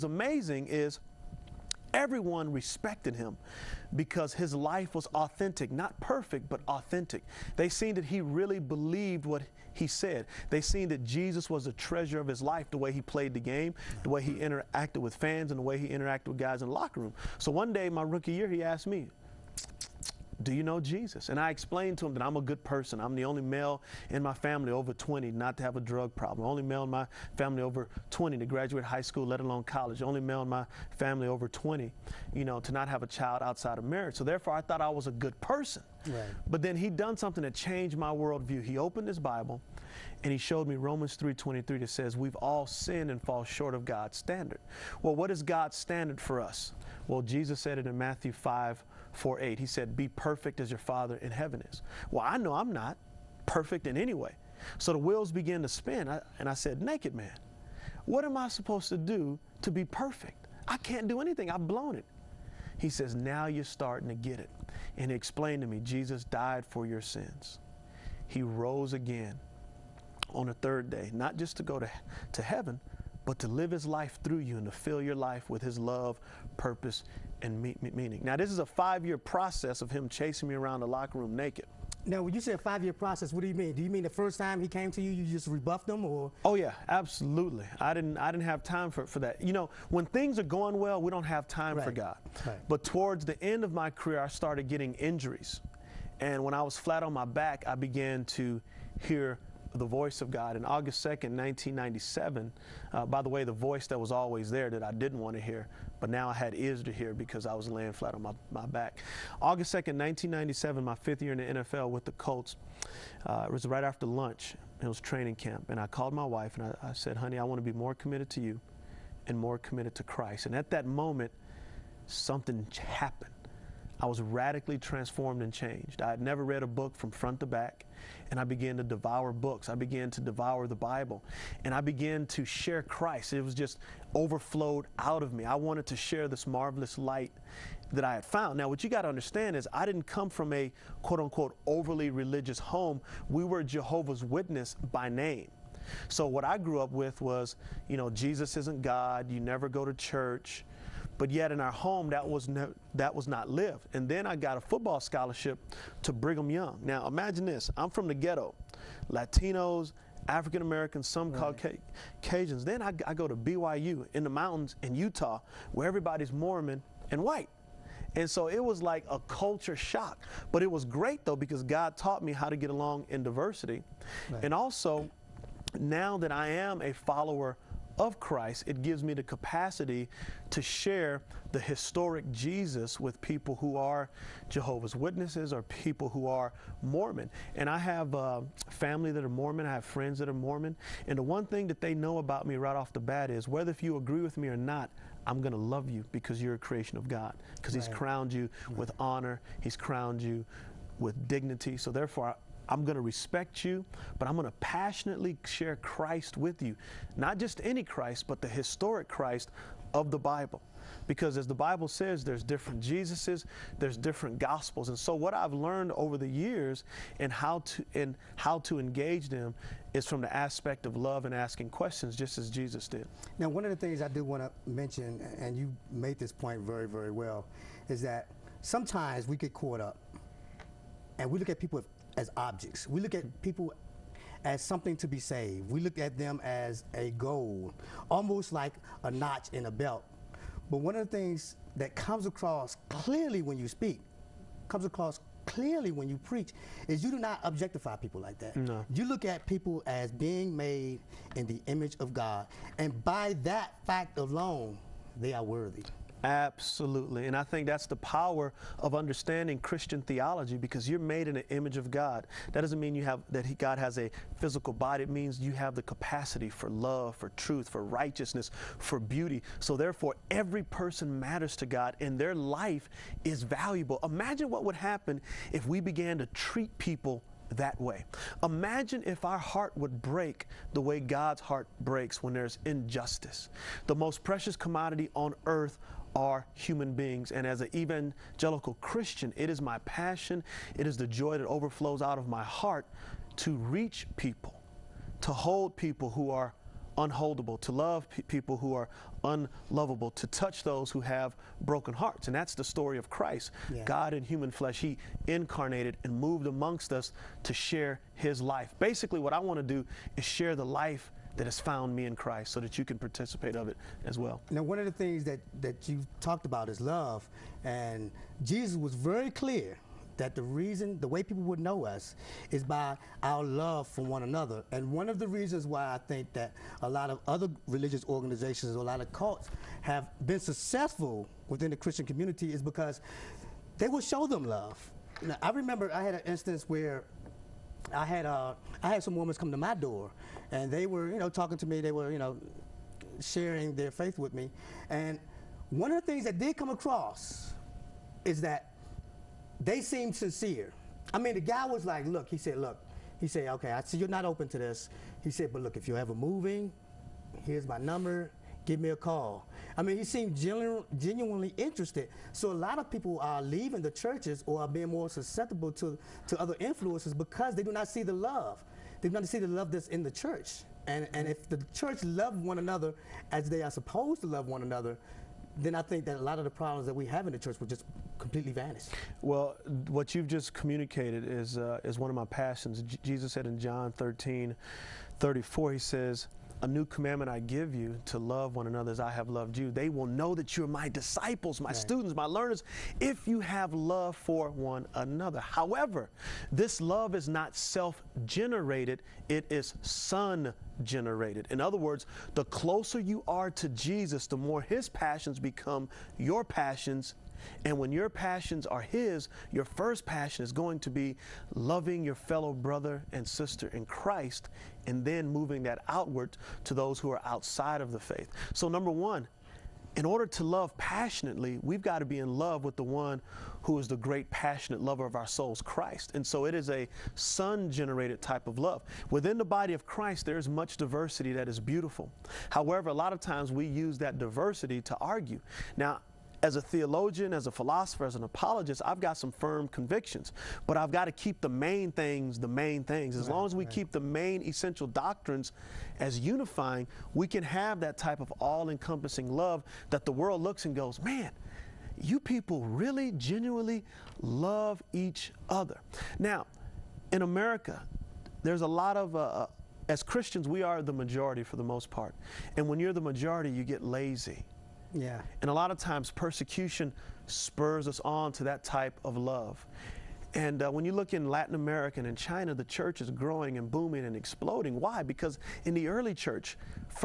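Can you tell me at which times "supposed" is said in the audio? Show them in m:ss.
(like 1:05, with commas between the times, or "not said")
0:58, 6:13.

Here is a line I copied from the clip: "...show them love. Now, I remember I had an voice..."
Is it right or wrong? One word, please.
wrong.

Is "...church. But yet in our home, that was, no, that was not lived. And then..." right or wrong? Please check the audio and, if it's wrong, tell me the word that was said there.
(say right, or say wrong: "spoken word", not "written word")
right.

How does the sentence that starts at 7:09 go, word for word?
Within the body of Christ, there is much diversity that is beautiful.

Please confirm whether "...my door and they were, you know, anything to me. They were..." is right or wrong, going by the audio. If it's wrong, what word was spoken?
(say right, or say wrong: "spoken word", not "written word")
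wrong: "talking", not "anything".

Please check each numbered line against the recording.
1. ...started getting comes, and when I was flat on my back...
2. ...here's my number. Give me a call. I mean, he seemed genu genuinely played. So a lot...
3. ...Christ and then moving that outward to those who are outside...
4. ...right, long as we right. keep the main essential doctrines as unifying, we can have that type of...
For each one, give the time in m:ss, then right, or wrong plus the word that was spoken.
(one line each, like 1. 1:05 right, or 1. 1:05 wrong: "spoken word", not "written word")
1. 1:34 wrong: "injuries", not "comes"
2. 5:57 wrong: "interested", not "played"
3. 6:53 right
4. 7:23 right.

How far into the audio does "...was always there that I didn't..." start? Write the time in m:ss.
1:43.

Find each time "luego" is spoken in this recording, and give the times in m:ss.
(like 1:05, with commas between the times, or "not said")
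not said.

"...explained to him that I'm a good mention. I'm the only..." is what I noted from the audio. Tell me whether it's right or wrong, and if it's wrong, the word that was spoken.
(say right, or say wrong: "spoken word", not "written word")
wrong: "person", not "mention".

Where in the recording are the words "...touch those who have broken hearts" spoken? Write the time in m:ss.
5:00.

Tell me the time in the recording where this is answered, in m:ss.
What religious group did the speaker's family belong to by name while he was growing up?
2:23.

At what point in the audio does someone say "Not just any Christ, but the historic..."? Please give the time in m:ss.
3:27.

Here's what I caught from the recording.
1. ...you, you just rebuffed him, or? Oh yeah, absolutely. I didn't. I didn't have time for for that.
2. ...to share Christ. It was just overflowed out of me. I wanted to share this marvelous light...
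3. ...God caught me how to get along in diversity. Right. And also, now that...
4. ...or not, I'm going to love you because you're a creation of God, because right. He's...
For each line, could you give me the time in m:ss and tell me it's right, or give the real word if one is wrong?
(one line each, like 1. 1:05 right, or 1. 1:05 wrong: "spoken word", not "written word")
1. 1:25 right
2. 2:12 right
3. 2:51 wrong: "taught", not "caught"
4. 3:14 right.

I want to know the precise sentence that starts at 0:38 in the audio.
He opened his Bible and he showed me Romans 3.23 that says, we've all sinned and fall short of God's standard.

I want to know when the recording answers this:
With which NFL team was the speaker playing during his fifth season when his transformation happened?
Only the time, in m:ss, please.
1:52.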